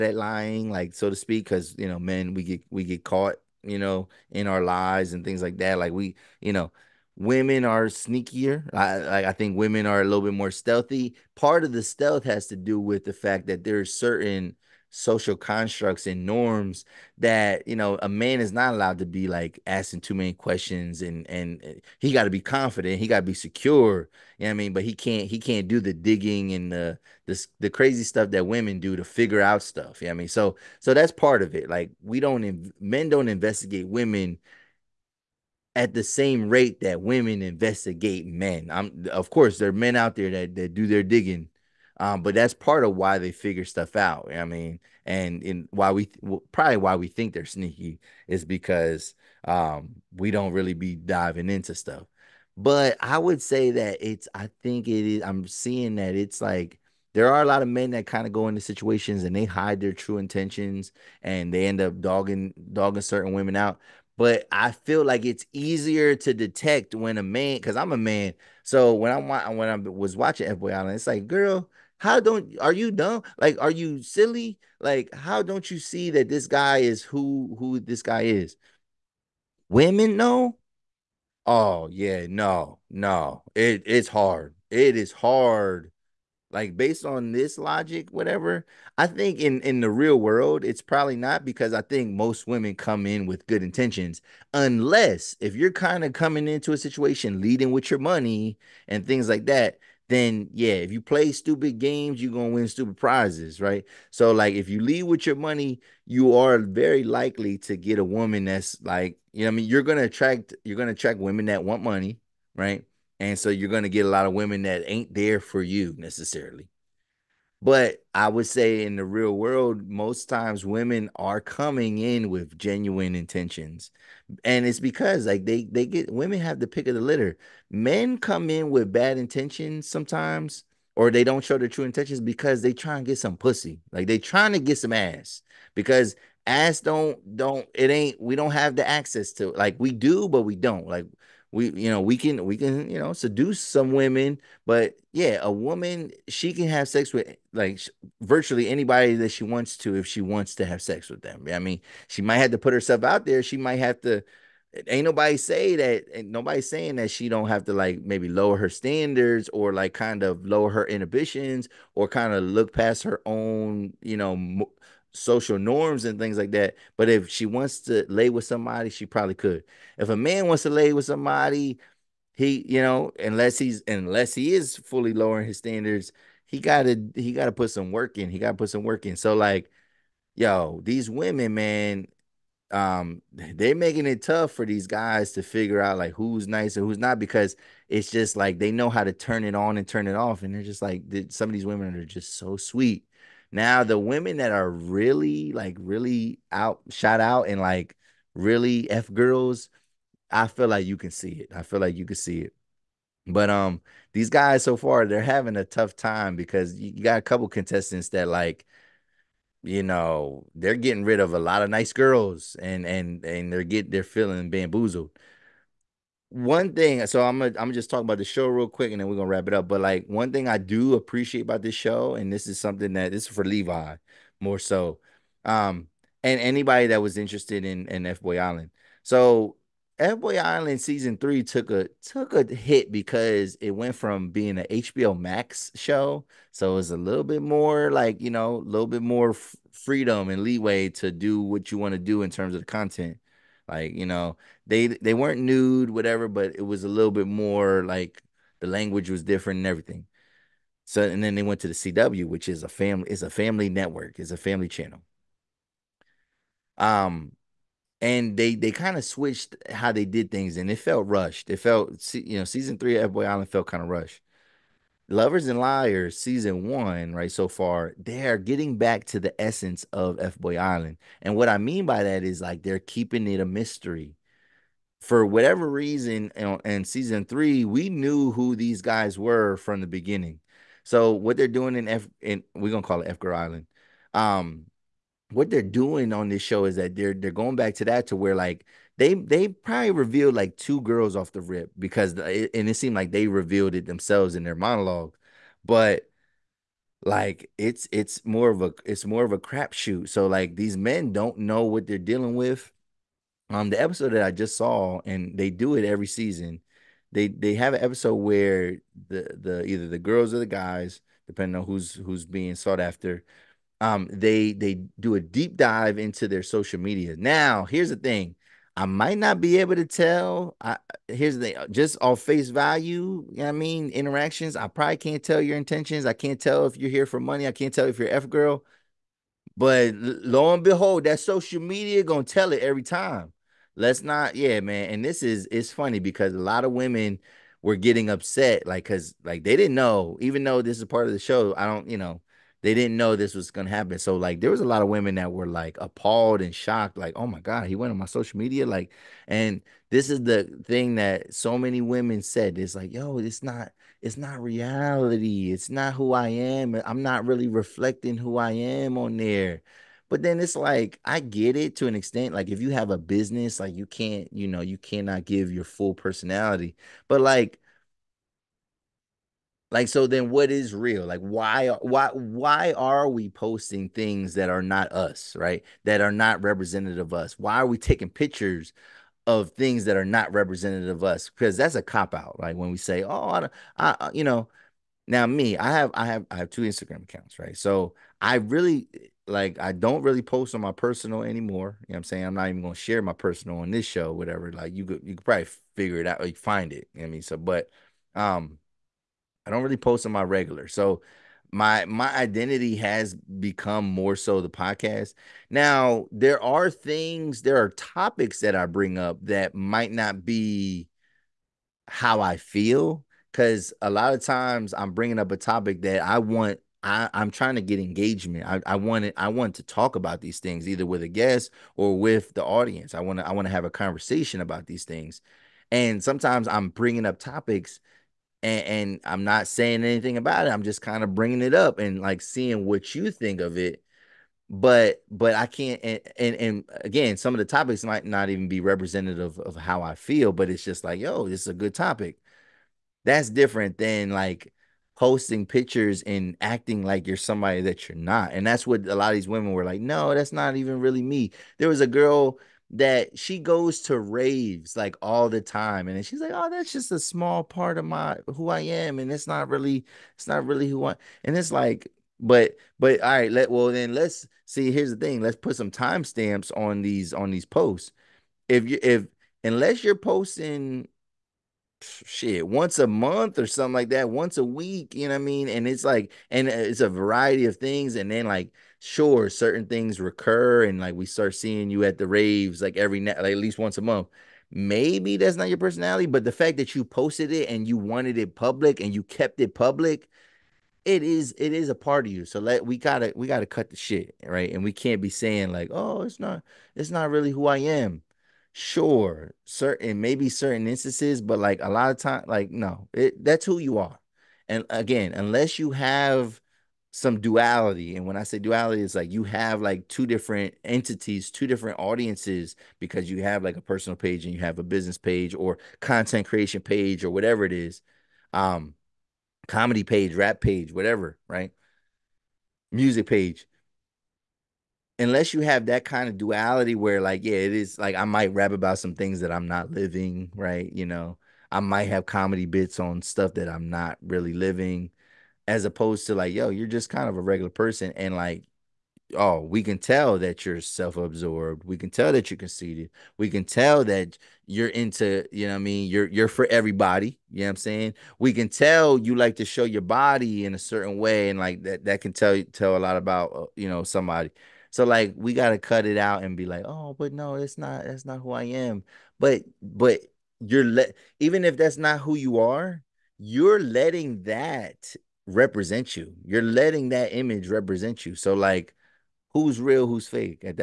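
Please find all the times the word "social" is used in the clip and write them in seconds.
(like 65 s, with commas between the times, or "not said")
14 s, 165 s, 316 s, 331 s, 348 s.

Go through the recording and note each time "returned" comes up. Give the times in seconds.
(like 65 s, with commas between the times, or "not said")
not said.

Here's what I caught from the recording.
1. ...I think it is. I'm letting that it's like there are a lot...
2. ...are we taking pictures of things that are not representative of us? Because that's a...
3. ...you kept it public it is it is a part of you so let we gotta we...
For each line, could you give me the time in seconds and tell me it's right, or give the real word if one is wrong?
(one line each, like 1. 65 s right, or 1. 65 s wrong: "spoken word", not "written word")
1. 54 s wrong: "seeing", not "letting"
2. 377 s right
3. 488 s right.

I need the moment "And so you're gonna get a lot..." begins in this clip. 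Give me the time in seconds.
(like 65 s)
113 s.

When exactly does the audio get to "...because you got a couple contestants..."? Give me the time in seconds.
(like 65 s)
206 s.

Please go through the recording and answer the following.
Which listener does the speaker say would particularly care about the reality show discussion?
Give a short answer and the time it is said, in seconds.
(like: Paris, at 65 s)
Levi, at 223 s.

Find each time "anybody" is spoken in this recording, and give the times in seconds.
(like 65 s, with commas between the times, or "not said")
148 s, 226 s.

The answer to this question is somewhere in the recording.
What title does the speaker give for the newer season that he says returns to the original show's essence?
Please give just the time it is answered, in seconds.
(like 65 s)
265 s.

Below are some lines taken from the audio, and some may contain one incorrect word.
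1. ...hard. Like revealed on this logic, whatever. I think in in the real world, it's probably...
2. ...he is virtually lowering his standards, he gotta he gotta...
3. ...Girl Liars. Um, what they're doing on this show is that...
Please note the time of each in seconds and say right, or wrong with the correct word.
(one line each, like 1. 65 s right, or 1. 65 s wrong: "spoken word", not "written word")
1. 85 s wrong: "based", not "revealed"
2. 174 s wrong: "fully", not "virtually"
3. 283 s wrong: "Island", not "Liars".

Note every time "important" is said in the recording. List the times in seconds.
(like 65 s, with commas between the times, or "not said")
not said.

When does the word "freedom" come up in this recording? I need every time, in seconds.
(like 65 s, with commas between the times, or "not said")
239 s.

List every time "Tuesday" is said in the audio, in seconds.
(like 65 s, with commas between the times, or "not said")
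not said.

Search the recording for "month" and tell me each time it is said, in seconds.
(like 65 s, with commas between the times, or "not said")
472 s, 483 s.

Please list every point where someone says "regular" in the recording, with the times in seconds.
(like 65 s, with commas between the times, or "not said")
400 s, 537 s.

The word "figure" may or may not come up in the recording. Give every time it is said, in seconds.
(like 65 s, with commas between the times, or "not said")
29 s, 43 s, 185 s, 395 s.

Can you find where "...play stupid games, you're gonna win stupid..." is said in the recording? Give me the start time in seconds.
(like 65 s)
100 s.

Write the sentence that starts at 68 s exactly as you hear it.
So when I'm when I was watching F Boy Island, it's like, girl, how don't are you dumb?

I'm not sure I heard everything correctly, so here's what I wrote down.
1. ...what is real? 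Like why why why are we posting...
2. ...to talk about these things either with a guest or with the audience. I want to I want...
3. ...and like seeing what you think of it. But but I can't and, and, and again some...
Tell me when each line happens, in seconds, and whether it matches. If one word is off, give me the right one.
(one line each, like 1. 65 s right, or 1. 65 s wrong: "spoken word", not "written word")
1. 370 s right
2. 419 s right
3. 431 s right.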